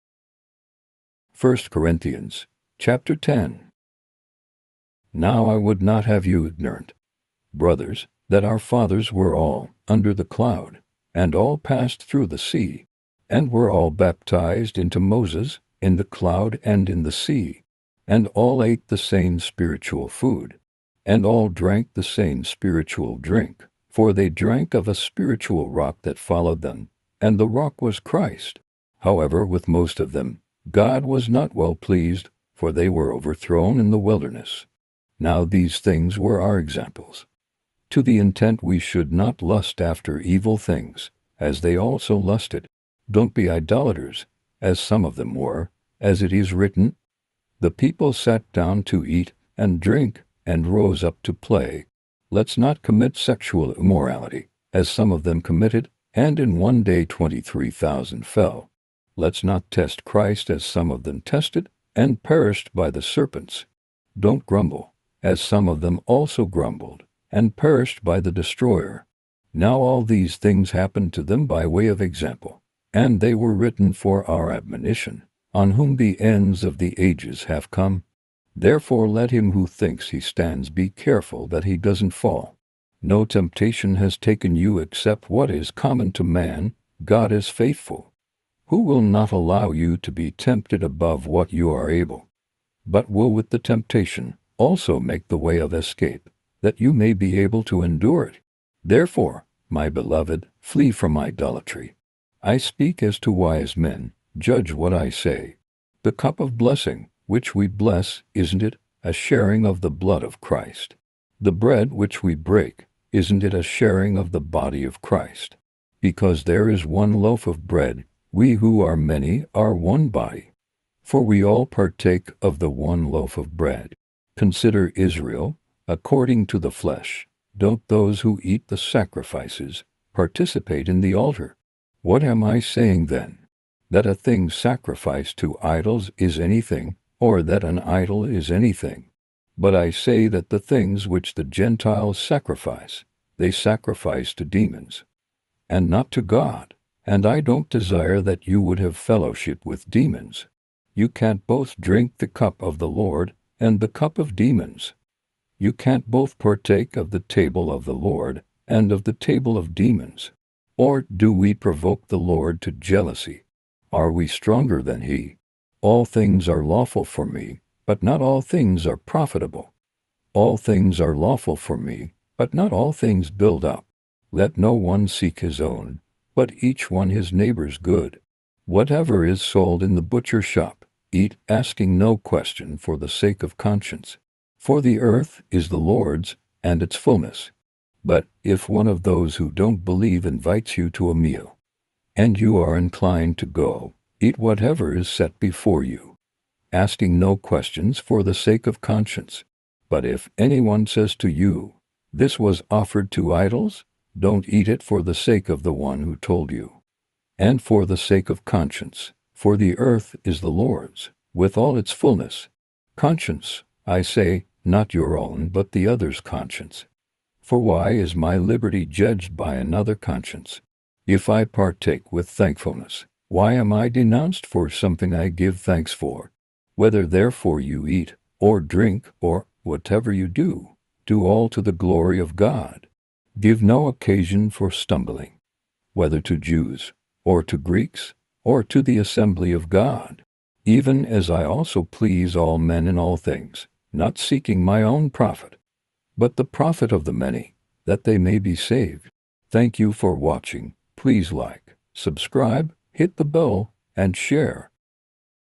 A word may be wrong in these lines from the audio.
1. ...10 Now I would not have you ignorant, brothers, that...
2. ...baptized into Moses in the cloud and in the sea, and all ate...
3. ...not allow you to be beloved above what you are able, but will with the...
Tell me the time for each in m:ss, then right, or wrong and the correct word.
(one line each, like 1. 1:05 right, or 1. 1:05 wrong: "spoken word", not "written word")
1. 0:03 right
2. 0:13 right
3. 1:29 wrong: "tempted", not "beloved".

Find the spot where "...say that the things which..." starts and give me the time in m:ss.
2:19.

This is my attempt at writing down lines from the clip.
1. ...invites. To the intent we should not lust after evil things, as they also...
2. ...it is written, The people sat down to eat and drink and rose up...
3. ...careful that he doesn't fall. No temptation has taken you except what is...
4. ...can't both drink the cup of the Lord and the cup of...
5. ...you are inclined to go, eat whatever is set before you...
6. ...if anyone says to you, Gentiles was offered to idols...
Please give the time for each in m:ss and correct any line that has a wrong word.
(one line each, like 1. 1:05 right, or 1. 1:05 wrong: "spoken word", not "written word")
1. 0:36 wrong: "examples", not "invites"
2. 0:46 right
3. 1:20 right
4. 2:31 right
5. 3:12 right
6. 3:20 wrong: "This", not "Gentiles".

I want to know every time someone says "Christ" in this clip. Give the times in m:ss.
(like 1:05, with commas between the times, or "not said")
0:27, 1:00, 1:50, 1:55.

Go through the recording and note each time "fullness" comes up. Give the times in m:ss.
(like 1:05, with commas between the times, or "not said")
3:06, 3:31.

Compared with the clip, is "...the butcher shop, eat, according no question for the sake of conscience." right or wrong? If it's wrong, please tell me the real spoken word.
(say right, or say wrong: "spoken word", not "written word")
wrong: "asking", not "according".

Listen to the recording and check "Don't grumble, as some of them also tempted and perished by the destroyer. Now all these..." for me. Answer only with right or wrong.
wrong.